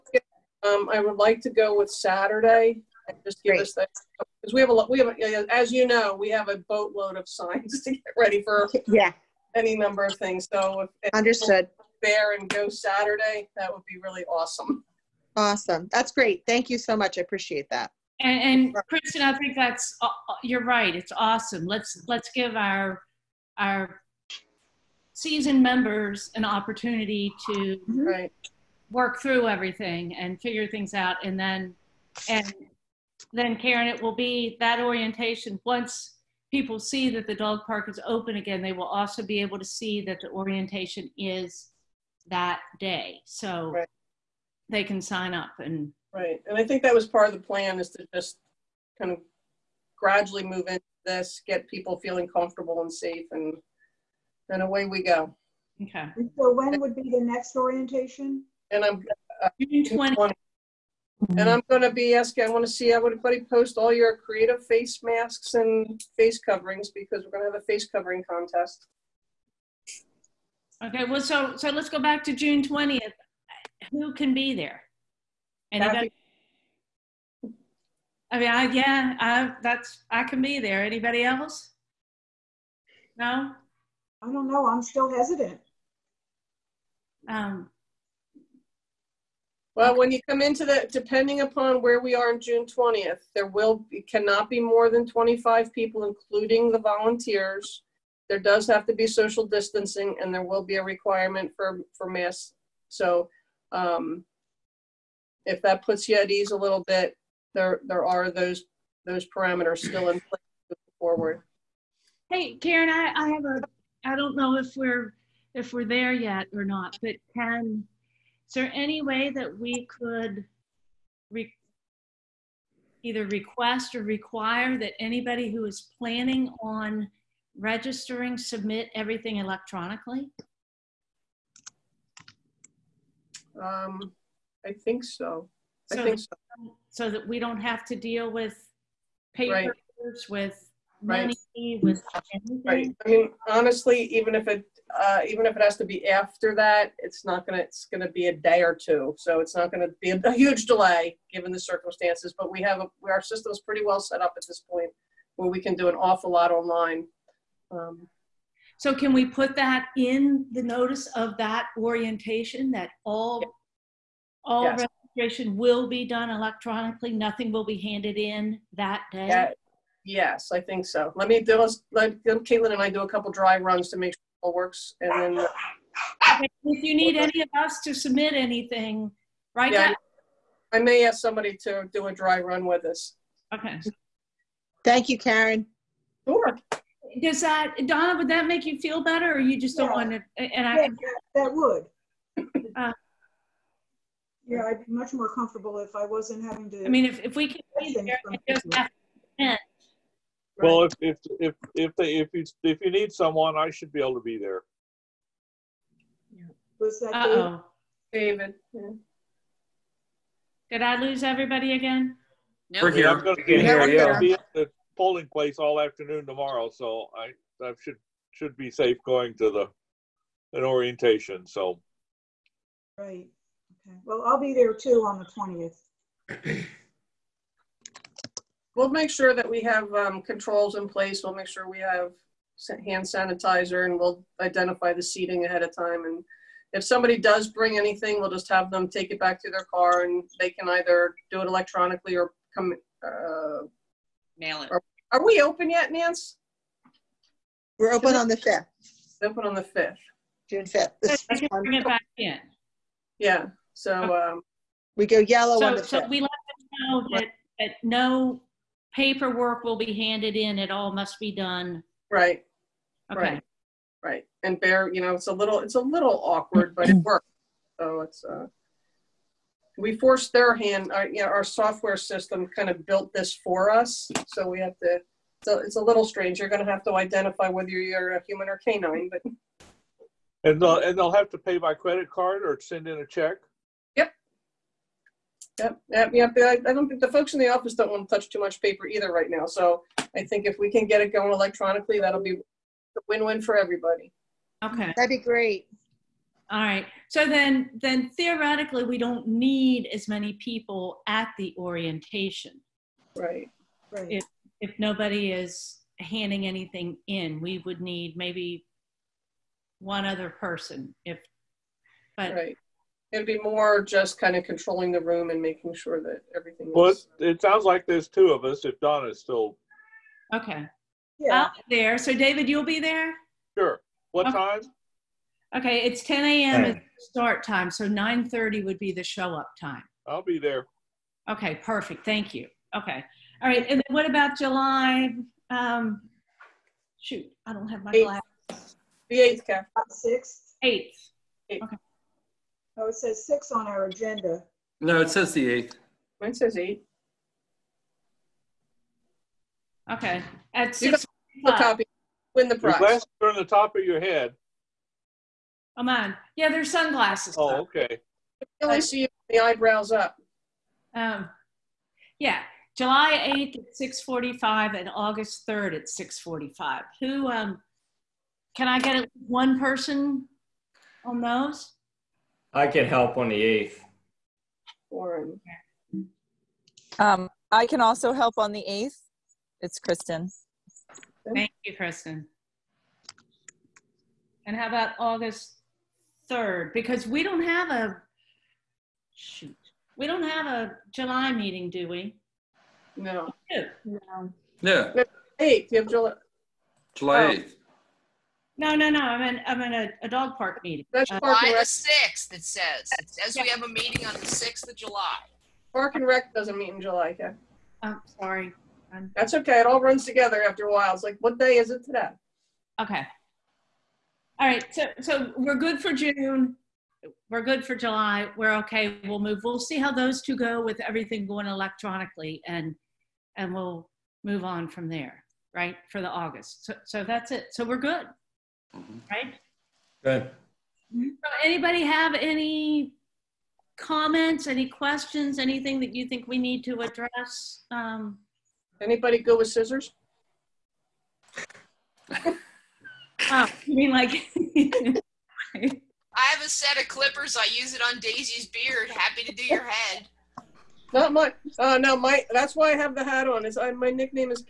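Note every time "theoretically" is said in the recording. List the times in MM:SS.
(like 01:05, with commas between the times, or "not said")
04:58.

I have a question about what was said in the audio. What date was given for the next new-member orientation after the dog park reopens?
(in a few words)
June 20.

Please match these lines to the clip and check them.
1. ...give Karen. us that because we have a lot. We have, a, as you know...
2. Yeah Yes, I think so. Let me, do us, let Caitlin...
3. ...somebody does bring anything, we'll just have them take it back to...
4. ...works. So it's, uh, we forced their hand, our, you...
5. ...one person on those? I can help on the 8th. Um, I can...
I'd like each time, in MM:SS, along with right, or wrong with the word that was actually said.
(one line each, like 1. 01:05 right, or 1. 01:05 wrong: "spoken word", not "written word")
1. 00:03 wrong: "Great", not "Karen"
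2. 02:49 right
3. 03:56 right
4. 04:26 right
5. 06:09 right.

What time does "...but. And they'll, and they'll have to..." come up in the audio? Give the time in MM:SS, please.
04:39.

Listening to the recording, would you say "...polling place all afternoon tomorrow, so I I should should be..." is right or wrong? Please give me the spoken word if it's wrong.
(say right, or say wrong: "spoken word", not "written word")
right.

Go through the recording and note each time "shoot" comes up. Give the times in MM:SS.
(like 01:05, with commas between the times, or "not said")
05:36, 06:29.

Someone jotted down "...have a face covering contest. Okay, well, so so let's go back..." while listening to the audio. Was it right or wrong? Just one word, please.
right.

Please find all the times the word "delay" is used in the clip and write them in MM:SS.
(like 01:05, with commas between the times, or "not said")
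02:30.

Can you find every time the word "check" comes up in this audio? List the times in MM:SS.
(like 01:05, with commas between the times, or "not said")
04:43.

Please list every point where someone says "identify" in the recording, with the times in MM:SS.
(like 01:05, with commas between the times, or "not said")
03:54, 04:36.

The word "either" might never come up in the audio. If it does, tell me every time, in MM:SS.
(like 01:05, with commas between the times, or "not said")
02:03, 04:00, 04:48.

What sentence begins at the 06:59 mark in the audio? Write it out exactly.
We'll see how those two go with everything going electronically and, and we'll move on from there, right?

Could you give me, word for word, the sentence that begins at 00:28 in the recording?
work through everything and figure things out, and then and then Karen, it will be that orientation.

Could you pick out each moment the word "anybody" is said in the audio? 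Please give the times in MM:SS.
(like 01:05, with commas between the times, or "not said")
01:15, 01:20, 02:05, 07:11, 07:18.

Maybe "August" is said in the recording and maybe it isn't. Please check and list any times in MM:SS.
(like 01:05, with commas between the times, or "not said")
06:04, 06:24, 07:06.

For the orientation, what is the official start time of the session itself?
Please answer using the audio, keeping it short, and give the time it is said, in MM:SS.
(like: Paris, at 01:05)
10 a.m., at 05:26.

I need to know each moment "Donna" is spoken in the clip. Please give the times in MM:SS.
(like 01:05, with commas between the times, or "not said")
03:07, 05:18.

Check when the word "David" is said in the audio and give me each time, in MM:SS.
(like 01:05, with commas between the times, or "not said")
03:28, 05:22.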